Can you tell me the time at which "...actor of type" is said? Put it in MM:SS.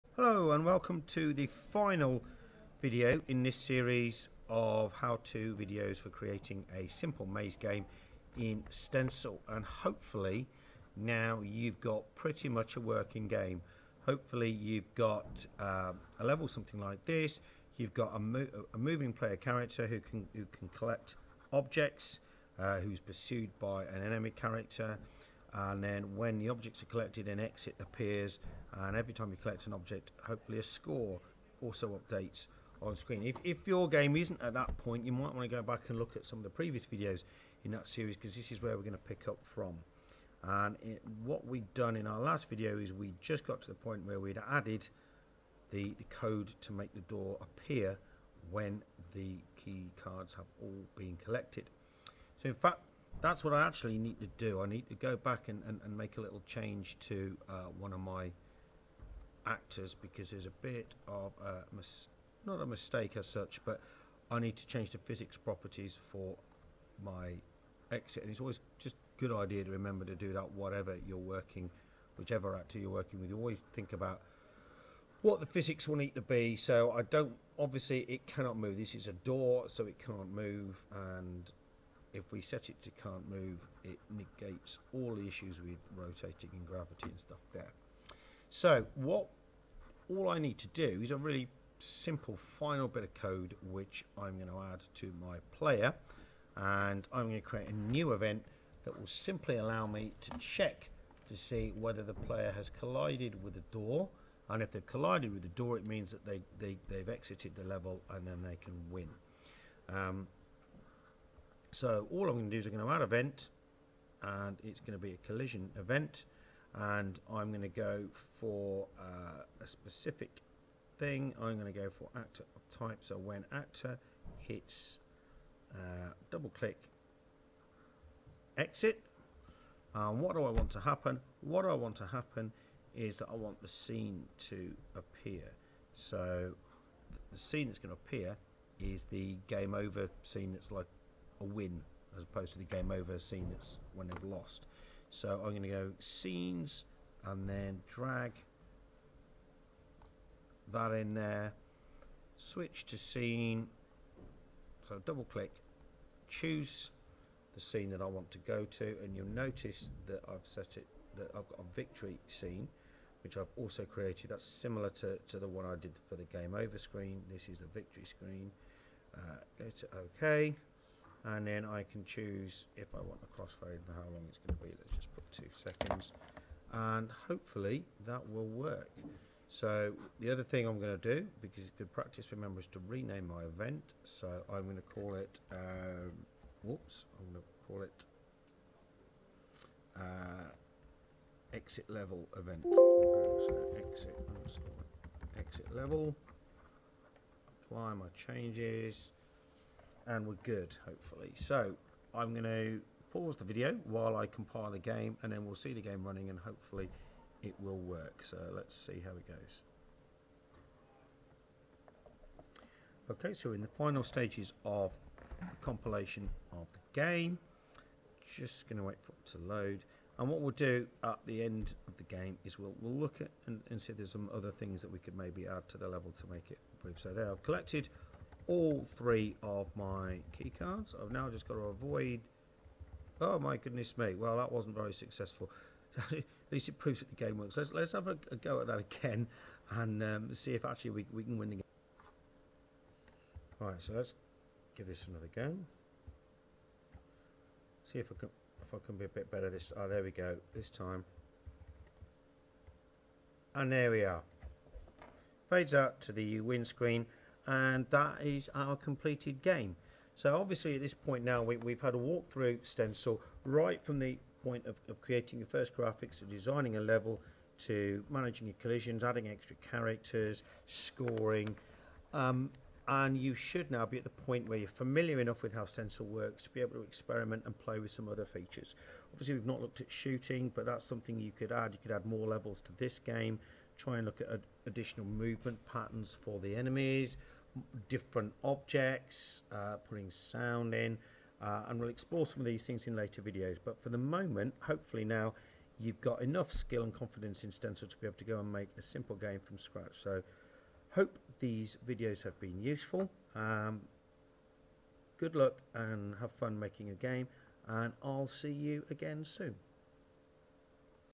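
02:02.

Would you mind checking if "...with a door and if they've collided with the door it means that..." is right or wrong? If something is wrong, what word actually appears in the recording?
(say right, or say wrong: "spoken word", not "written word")
right.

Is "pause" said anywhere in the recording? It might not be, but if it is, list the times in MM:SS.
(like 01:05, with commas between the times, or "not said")
03:23.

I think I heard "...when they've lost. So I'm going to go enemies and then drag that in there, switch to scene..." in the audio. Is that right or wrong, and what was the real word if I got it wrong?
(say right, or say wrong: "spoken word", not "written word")
wrong: "scenes", not "enemies".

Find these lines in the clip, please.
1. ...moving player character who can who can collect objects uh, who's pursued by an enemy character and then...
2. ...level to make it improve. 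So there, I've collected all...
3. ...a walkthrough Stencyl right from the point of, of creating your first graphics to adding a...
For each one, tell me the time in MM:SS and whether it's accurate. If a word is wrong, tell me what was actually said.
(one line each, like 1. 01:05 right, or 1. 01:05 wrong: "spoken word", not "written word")
1. 00:18 right
2. 03:45 right
3. 04:21 wrong: "designing", not "adding".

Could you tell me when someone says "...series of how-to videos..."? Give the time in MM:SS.
00:03.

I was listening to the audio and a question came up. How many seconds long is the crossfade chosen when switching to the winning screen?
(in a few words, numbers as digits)
2.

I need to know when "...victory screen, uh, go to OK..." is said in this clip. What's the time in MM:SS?
02:47.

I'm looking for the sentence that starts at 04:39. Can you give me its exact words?
Obviously we've not looked at shooting, but that's something you could add.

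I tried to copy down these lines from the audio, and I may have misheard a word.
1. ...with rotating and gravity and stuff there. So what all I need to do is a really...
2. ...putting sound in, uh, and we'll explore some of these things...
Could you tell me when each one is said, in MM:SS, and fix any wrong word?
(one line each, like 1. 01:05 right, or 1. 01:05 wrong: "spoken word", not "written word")
1. 01:25 right
2. 04:49 right.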